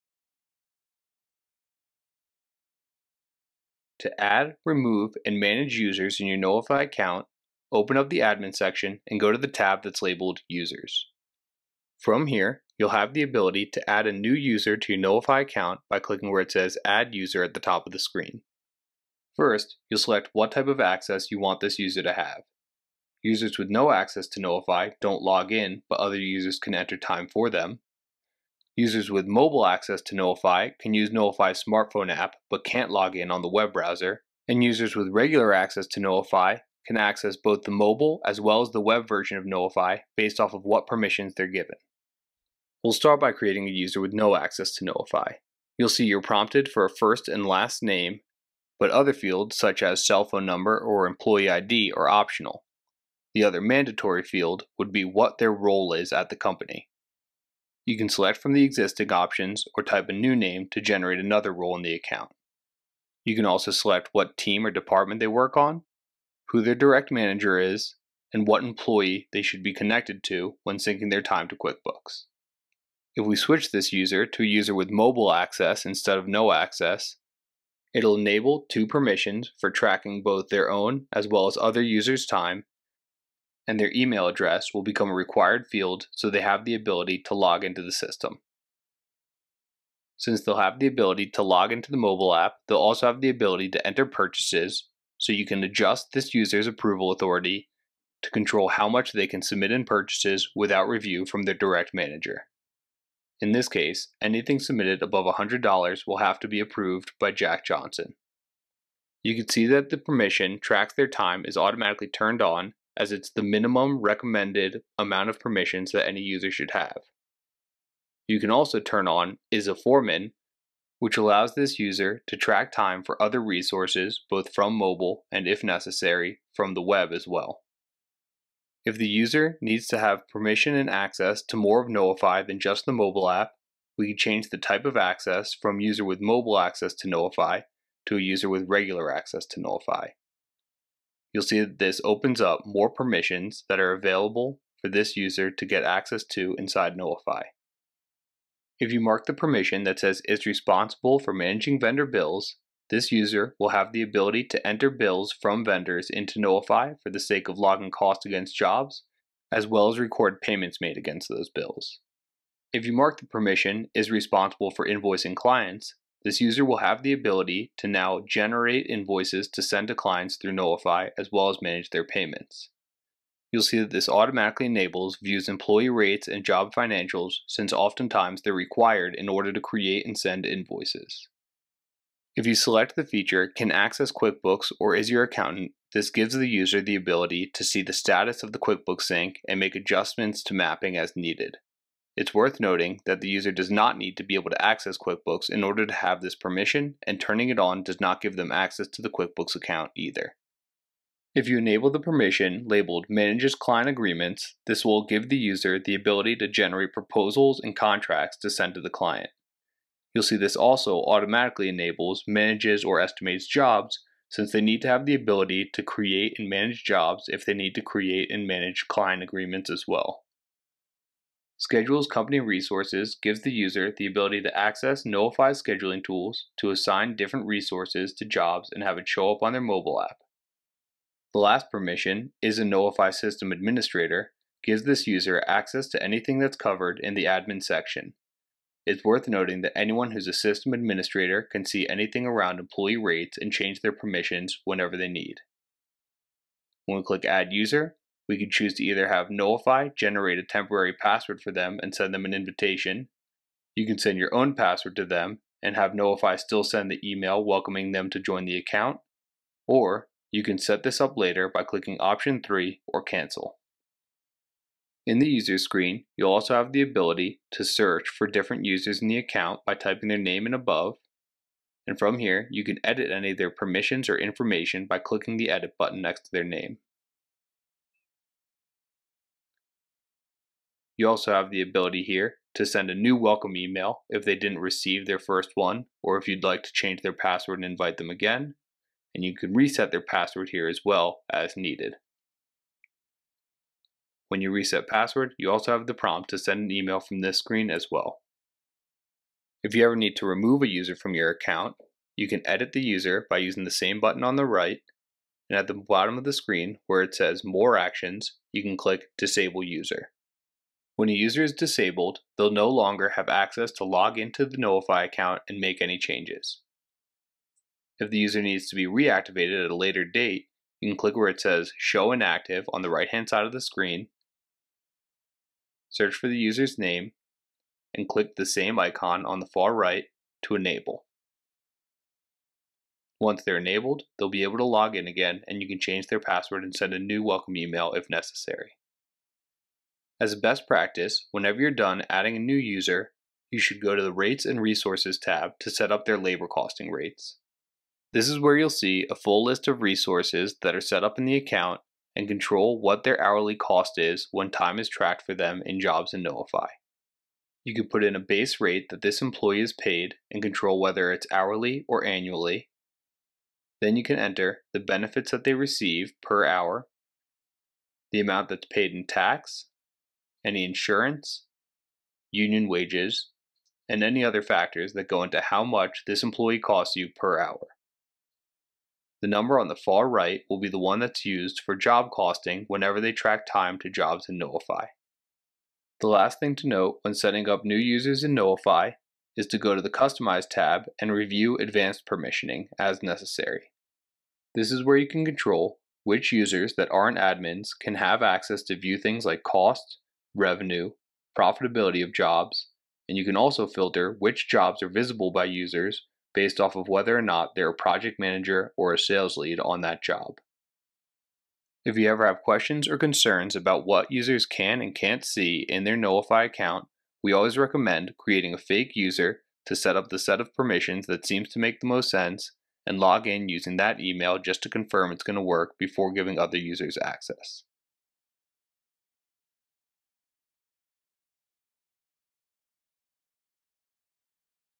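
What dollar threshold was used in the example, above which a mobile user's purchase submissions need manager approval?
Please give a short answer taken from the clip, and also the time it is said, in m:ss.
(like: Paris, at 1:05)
$100, at 1:45.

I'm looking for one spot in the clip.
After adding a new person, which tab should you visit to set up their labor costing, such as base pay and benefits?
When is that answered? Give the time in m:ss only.
5:44.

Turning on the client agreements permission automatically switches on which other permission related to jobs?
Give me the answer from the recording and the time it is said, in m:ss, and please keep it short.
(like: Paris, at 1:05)
Manages or Estimates Jobs, at 3:32.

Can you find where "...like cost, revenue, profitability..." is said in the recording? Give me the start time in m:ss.
6:39.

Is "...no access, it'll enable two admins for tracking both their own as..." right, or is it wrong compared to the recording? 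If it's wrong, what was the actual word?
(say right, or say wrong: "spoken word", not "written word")
wrong: "permissions", not "admins".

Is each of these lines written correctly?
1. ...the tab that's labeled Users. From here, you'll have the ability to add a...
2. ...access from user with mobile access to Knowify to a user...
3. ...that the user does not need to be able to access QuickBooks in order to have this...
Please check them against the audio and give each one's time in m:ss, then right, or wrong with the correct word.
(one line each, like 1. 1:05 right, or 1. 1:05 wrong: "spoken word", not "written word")
1. 0:09 right
2. 2:14 right
3. 3:13 right.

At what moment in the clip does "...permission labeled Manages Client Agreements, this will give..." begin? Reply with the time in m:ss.
3:22.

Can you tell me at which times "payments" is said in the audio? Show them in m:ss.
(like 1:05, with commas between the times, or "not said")
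2:40, 2:52.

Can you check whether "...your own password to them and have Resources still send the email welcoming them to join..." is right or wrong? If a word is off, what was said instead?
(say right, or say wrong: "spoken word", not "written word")
wrong: "Knowify", not "Resources".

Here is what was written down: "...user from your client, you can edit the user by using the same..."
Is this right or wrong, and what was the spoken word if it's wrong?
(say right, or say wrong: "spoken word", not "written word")
wrong: "account", not "client".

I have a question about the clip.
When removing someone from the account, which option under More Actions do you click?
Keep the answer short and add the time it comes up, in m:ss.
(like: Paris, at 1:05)
Disable User, at 5:09.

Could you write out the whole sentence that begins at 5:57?
You can put in a base rate that this employee is paid and control whether it's hourly or annually.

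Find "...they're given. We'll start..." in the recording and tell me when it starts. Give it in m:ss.
0:41.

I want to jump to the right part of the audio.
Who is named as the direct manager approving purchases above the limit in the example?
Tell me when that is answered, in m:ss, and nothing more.
1:47.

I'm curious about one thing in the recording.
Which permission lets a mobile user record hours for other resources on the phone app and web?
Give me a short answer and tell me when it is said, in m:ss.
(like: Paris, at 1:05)
Is a foreman, at 1:59.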